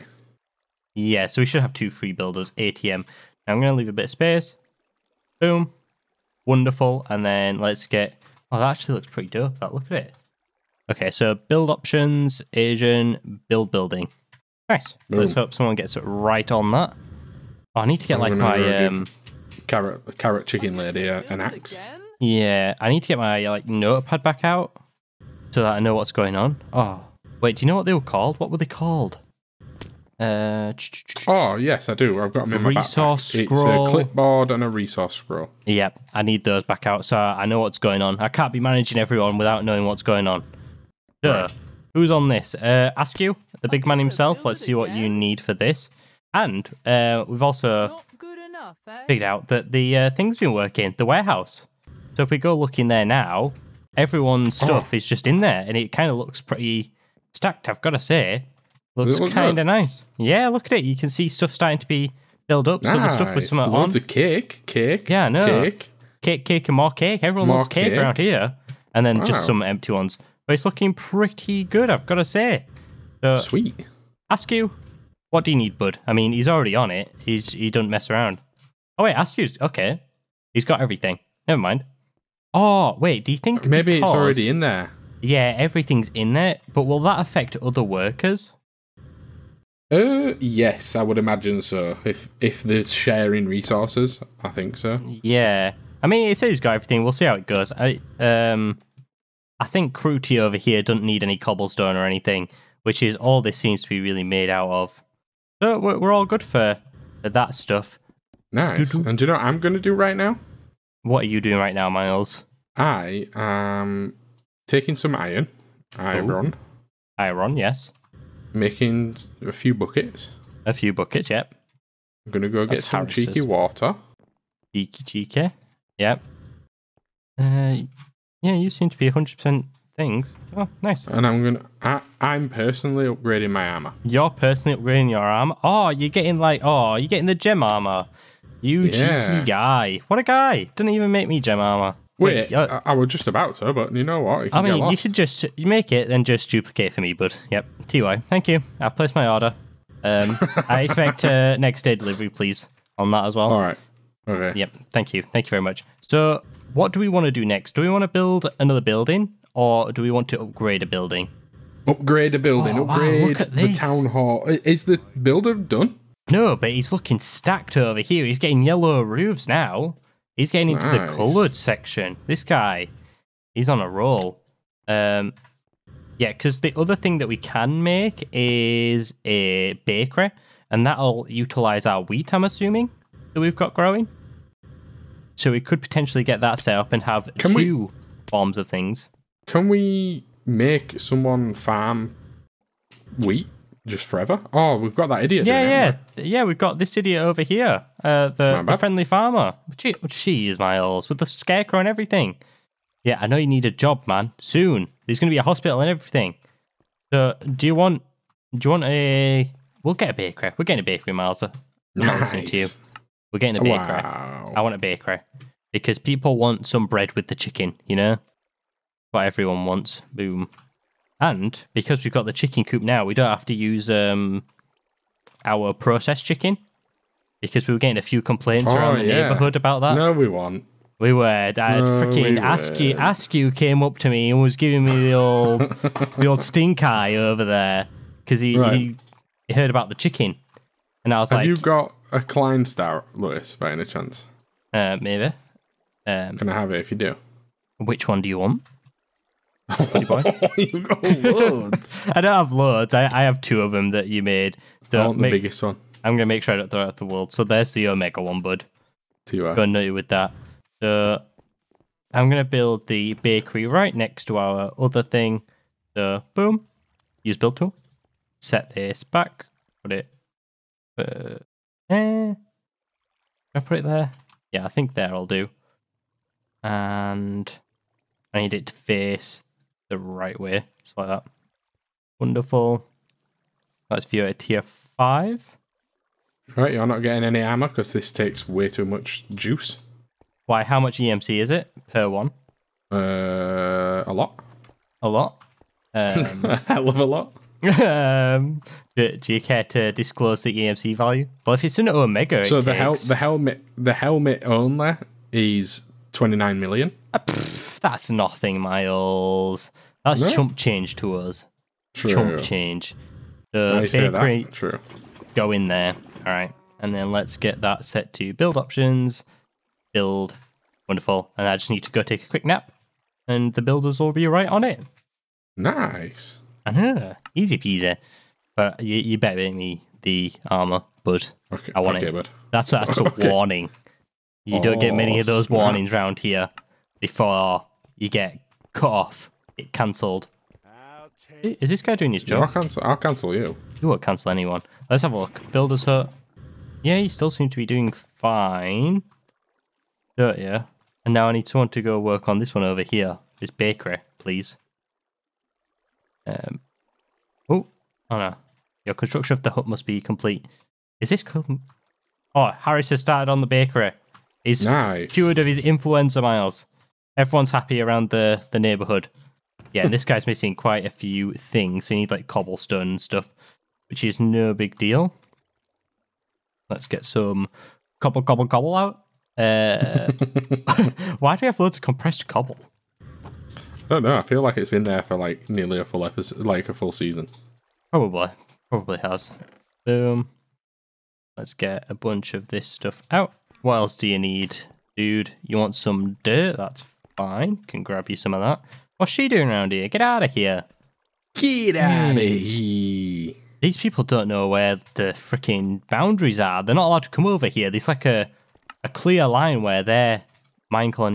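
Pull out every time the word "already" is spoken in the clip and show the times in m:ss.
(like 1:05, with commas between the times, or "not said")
1:16, 1:24.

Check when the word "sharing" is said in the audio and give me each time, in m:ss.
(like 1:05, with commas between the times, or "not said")
1:32.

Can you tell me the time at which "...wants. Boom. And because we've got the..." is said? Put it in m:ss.
3:39.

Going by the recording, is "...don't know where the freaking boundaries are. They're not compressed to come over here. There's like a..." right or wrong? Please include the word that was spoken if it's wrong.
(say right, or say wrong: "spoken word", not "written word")
wrong: "allowed", not "compressed".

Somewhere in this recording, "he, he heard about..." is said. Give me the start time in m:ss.
3:58.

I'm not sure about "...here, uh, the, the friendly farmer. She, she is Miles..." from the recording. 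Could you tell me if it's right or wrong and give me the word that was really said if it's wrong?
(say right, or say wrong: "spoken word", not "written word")
right.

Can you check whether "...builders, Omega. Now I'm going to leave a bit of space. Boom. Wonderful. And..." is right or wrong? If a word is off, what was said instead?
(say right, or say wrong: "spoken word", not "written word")
wrong: "ATM", not "Omega".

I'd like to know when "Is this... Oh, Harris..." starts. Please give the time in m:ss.
6:01.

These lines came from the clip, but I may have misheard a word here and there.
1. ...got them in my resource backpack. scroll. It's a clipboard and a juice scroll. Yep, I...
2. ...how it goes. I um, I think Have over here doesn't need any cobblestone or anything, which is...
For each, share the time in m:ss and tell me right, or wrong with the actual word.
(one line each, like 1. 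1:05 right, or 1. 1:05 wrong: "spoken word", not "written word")
1. 0:32 wrong: "resource", not "juice"
2. 1:37 wrong: "Cruti", not "Have".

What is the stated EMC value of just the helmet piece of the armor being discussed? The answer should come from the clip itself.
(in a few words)
29 million.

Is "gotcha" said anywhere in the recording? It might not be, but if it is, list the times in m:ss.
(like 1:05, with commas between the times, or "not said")
not said.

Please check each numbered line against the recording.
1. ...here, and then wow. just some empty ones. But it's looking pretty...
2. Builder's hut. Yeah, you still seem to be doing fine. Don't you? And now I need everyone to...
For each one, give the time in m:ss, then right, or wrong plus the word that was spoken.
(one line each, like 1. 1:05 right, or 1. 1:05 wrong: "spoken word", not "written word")
1. 1:08 right
2. 5:45 wrong: "someone", not "everyone".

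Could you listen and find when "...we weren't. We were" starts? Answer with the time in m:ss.
3:50.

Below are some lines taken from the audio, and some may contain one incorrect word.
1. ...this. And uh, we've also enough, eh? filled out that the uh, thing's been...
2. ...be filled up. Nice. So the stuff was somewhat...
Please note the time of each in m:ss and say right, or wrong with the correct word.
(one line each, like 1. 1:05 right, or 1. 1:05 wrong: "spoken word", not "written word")
1. 0:45 wrong: "figured", not "filled"
2. 1:01 right.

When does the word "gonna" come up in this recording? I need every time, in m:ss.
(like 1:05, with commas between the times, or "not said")
2:02, 2:11, 4:16, 4:22.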